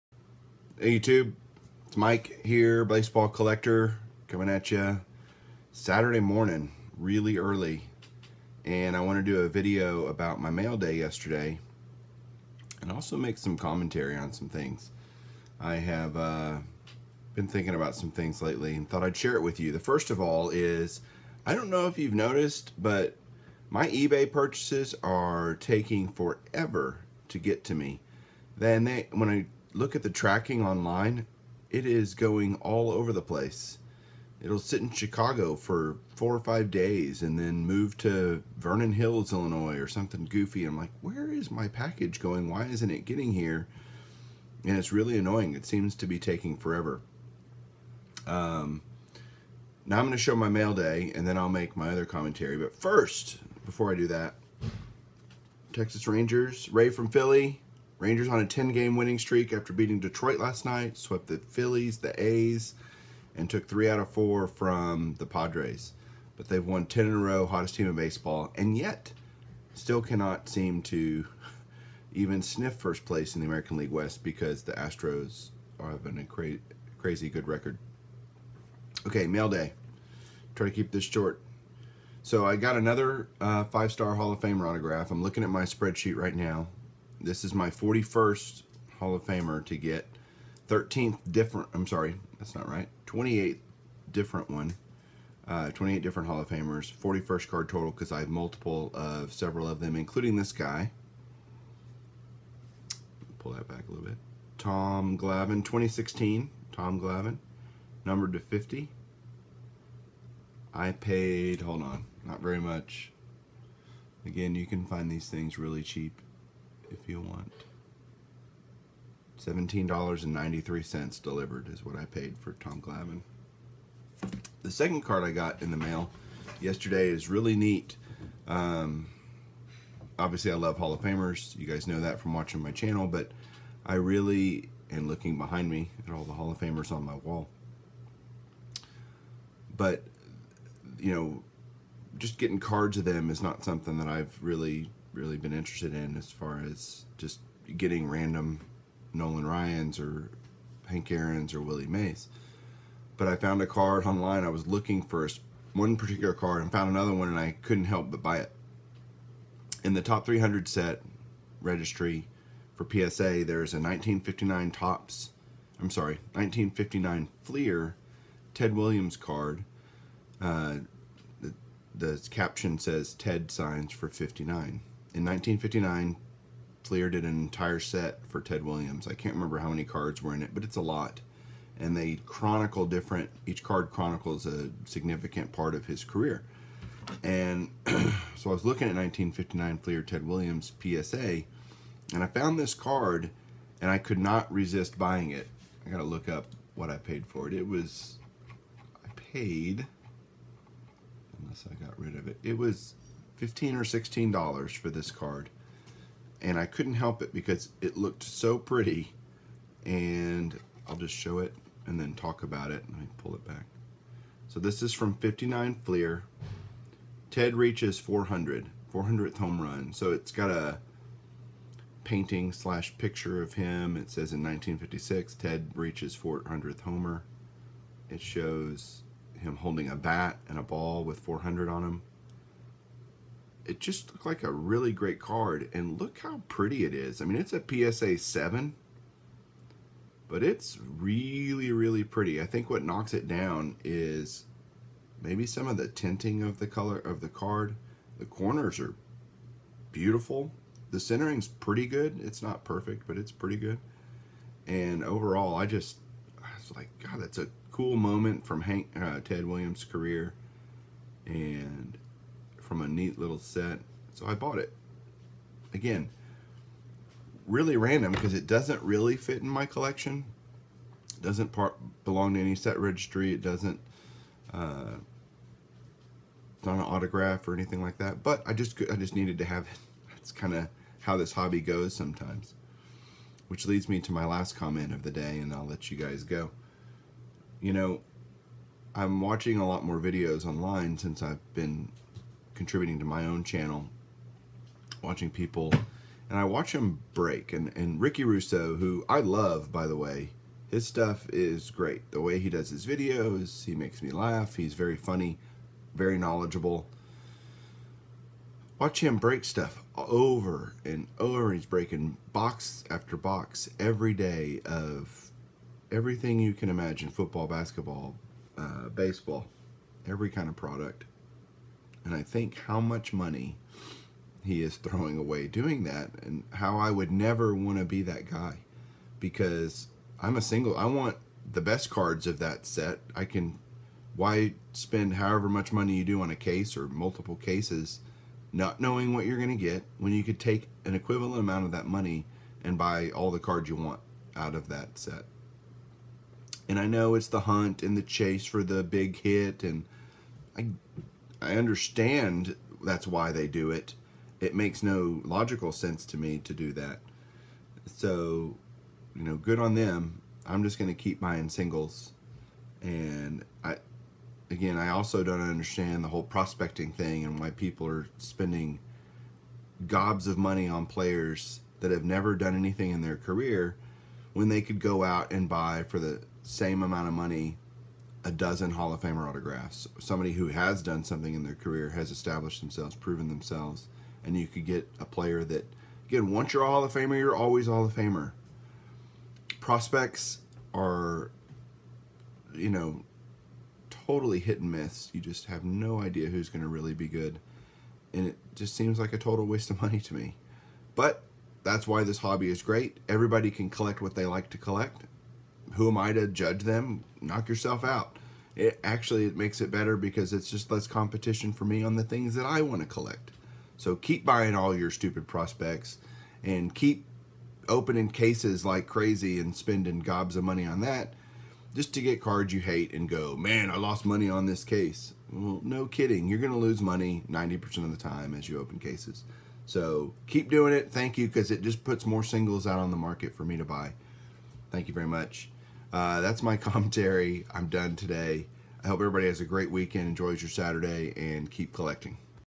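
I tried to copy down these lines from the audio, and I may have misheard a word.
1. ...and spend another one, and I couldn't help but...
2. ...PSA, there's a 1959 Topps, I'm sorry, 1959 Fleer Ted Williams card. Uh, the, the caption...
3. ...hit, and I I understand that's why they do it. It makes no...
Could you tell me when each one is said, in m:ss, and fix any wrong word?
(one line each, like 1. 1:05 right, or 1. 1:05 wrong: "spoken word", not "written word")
1. 2:36 wrong: "found", not "spend"
2. 2:42 right
3. 5:49 right.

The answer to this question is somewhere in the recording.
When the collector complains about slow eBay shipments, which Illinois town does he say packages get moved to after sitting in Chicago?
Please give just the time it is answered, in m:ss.
0:38.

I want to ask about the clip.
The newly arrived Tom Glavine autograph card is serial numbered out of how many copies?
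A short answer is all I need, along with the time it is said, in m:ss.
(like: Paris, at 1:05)
50, at 1:48.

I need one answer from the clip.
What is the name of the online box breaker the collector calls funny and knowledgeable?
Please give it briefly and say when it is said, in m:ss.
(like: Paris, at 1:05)
Ricky Russo, at 4:57.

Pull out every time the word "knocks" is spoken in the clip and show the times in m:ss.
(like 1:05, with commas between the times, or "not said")
4:02, 6:47.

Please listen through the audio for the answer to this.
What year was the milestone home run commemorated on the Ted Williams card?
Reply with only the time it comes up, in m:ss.
3:44.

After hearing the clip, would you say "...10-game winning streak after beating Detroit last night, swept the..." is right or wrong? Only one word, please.
right.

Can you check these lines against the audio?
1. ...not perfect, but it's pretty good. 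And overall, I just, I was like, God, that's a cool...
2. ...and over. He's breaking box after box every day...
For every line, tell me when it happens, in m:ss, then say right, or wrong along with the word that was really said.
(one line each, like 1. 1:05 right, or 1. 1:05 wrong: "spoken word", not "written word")
1. 4:12 right
2. 5:10 right.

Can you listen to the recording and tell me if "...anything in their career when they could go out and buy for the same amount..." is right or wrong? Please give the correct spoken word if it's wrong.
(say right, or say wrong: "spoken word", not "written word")
right.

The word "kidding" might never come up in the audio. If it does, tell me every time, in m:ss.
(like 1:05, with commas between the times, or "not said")
7:05.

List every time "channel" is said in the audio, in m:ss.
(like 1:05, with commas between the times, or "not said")
2:12, 4:53.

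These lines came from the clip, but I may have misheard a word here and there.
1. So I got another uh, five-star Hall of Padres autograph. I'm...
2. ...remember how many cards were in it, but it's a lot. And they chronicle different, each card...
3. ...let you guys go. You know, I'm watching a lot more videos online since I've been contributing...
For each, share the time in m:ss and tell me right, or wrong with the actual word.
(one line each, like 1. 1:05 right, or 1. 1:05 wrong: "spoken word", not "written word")
1. 1:22 wrong: "Famer", not "Padres"
2. 2:59 right
3. 4:45 right.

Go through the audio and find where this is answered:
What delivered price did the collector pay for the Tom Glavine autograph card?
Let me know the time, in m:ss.
1:59.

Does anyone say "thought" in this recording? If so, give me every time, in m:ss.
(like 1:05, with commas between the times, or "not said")
0:18.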